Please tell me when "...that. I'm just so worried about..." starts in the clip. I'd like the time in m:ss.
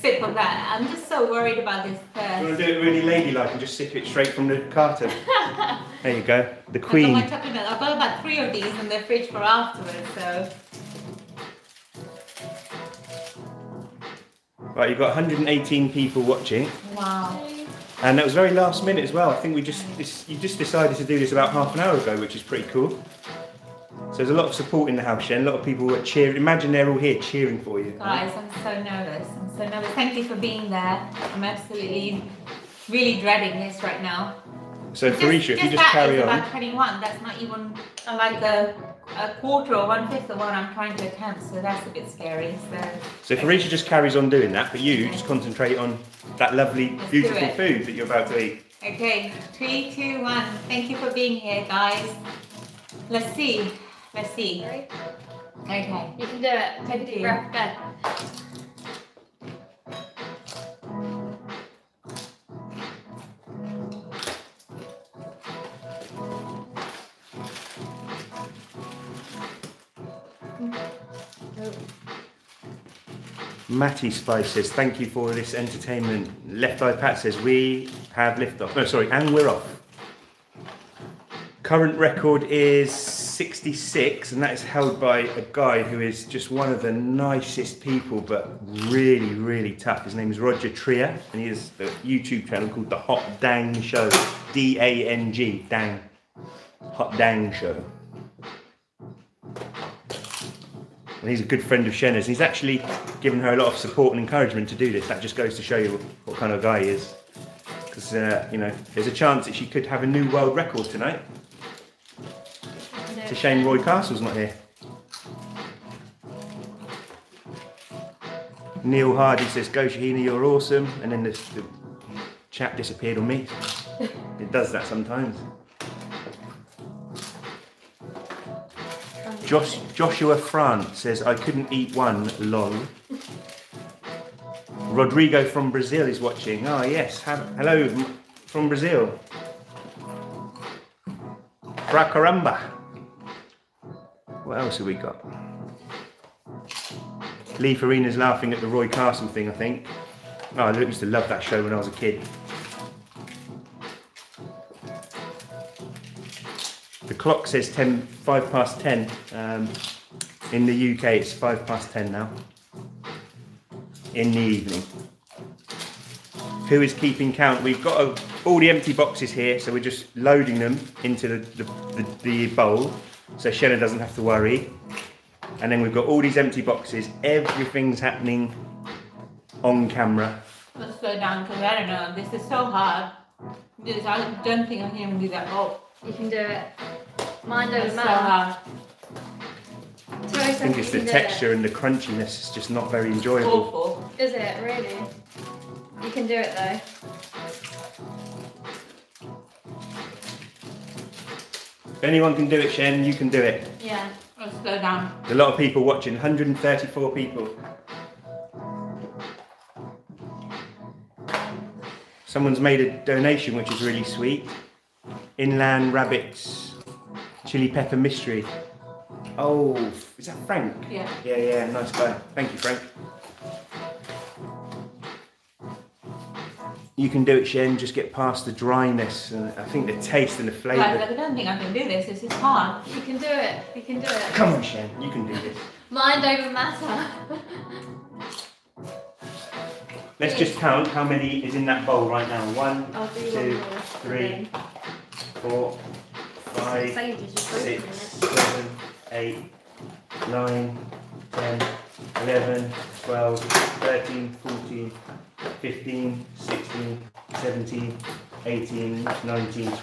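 0:00.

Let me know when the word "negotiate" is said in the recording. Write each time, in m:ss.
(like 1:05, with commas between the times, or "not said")
not said.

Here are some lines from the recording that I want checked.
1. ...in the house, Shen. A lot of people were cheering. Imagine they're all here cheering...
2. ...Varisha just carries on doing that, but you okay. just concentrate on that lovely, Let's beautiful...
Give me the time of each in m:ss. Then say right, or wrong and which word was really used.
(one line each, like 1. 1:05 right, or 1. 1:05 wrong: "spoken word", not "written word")
1. 0:24 right
2. 0:43 right.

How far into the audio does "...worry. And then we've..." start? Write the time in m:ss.
2:54.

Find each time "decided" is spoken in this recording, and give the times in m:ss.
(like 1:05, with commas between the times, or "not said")
0:20.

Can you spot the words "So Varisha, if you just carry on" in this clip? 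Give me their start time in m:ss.
0:34.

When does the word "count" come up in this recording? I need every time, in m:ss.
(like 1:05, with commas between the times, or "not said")
2:47, 4:00.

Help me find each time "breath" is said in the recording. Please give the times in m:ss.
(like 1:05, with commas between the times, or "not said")
0:57.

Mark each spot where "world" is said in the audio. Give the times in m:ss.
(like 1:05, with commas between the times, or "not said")
1:50.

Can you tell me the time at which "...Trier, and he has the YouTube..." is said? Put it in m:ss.
1:30.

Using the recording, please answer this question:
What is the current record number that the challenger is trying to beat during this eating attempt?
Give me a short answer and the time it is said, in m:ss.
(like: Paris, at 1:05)
66, at 1:22.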